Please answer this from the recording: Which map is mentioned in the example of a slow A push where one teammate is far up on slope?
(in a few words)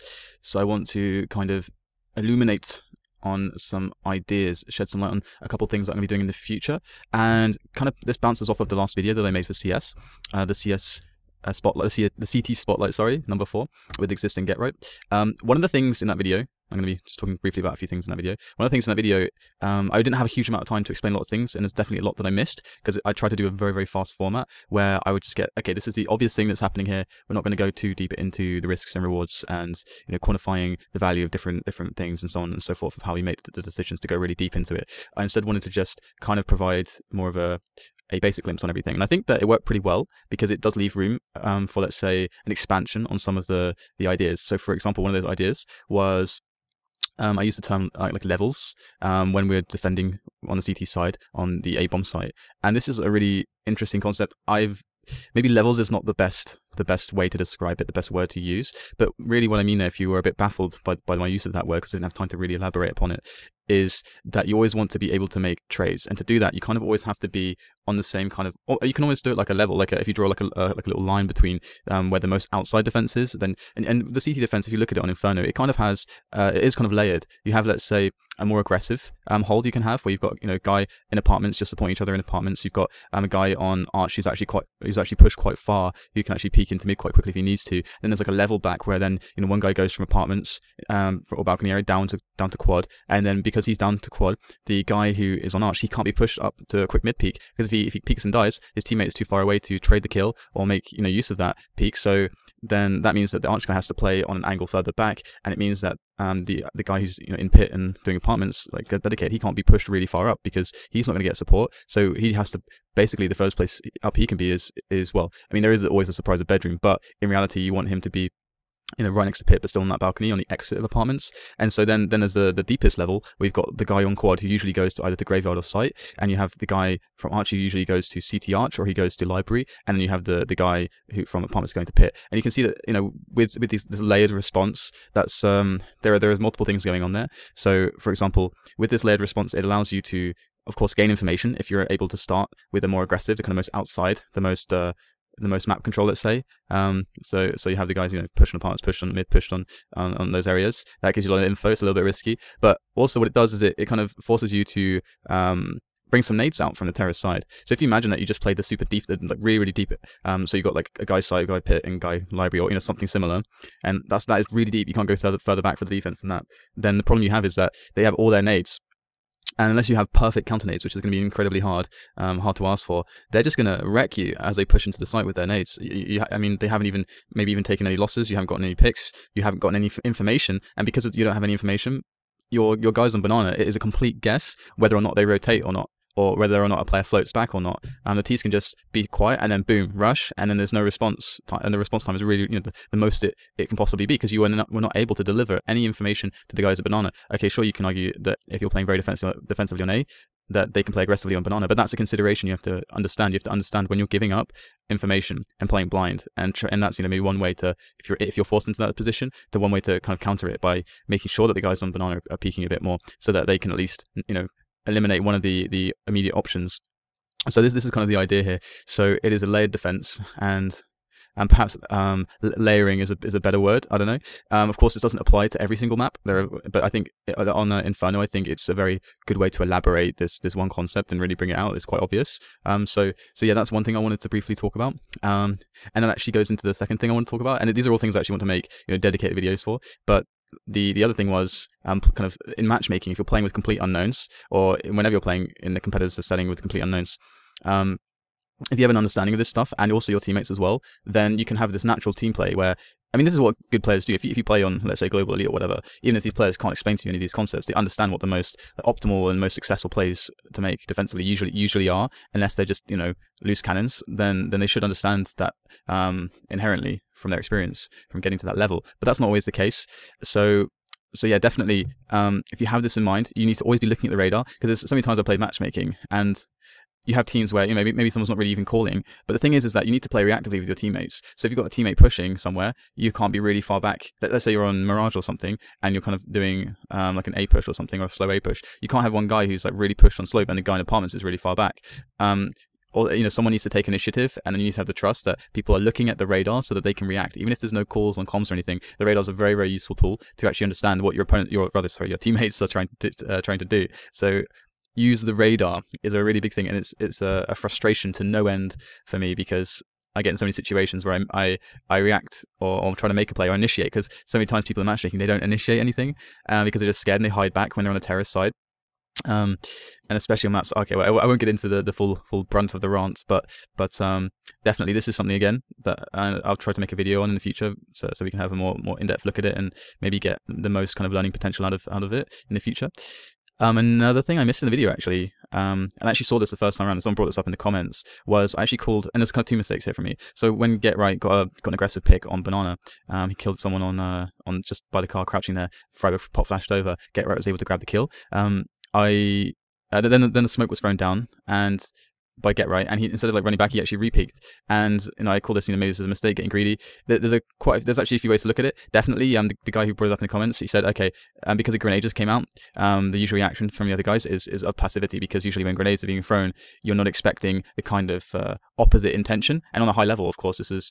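Mirage.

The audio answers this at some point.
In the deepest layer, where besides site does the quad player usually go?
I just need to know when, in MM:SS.
02:05.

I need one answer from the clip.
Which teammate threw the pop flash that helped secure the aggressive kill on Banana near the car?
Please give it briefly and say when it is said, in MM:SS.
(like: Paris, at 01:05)
friberg, at 05:45.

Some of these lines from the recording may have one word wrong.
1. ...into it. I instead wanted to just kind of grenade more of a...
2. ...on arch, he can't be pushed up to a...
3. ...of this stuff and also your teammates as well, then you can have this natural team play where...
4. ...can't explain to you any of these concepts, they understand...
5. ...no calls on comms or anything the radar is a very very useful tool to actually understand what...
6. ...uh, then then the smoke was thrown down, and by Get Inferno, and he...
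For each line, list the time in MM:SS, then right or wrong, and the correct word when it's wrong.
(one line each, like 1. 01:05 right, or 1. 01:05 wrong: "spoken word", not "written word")
1. 00:34 wrong: "provide", not "grenade"
2. 01:35 right
3. 04:09 right
4. 04:16 right
5. 04:57 right
6. 05:49 wrong: "Right", not "Inferno".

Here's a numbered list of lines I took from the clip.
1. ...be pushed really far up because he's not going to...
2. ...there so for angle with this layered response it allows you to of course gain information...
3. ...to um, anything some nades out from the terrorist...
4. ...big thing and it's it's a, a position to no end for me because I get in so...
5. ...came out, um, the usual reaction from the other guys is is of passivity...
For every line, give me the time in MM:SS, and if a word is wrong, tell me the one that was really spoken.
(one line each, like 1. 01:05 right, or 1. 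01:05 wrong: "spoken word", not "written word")
1. 01:49 right
2. 02:17 wrong: "example", not "angle"
3. 02:34 wrong: "bring", not "anything"
4. 05:06 wrong: "frustration", not "position"
5. 06:02 right.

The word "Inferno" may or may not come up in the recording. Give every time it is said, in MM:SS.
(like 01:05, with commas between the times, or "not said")
01:15, 03:47.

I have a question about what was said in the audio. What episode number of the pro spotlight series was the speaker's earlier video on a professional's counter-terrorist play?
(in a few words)
4.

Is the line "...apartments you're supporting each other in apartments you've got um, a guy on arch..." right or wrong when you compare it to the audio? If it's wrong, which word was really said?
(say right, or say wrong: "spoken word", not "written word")
right.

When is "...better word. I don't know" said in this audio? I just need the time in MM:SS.
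03:43.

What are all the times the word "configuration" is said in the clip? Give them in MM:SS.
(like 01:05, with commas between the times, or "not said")
not said.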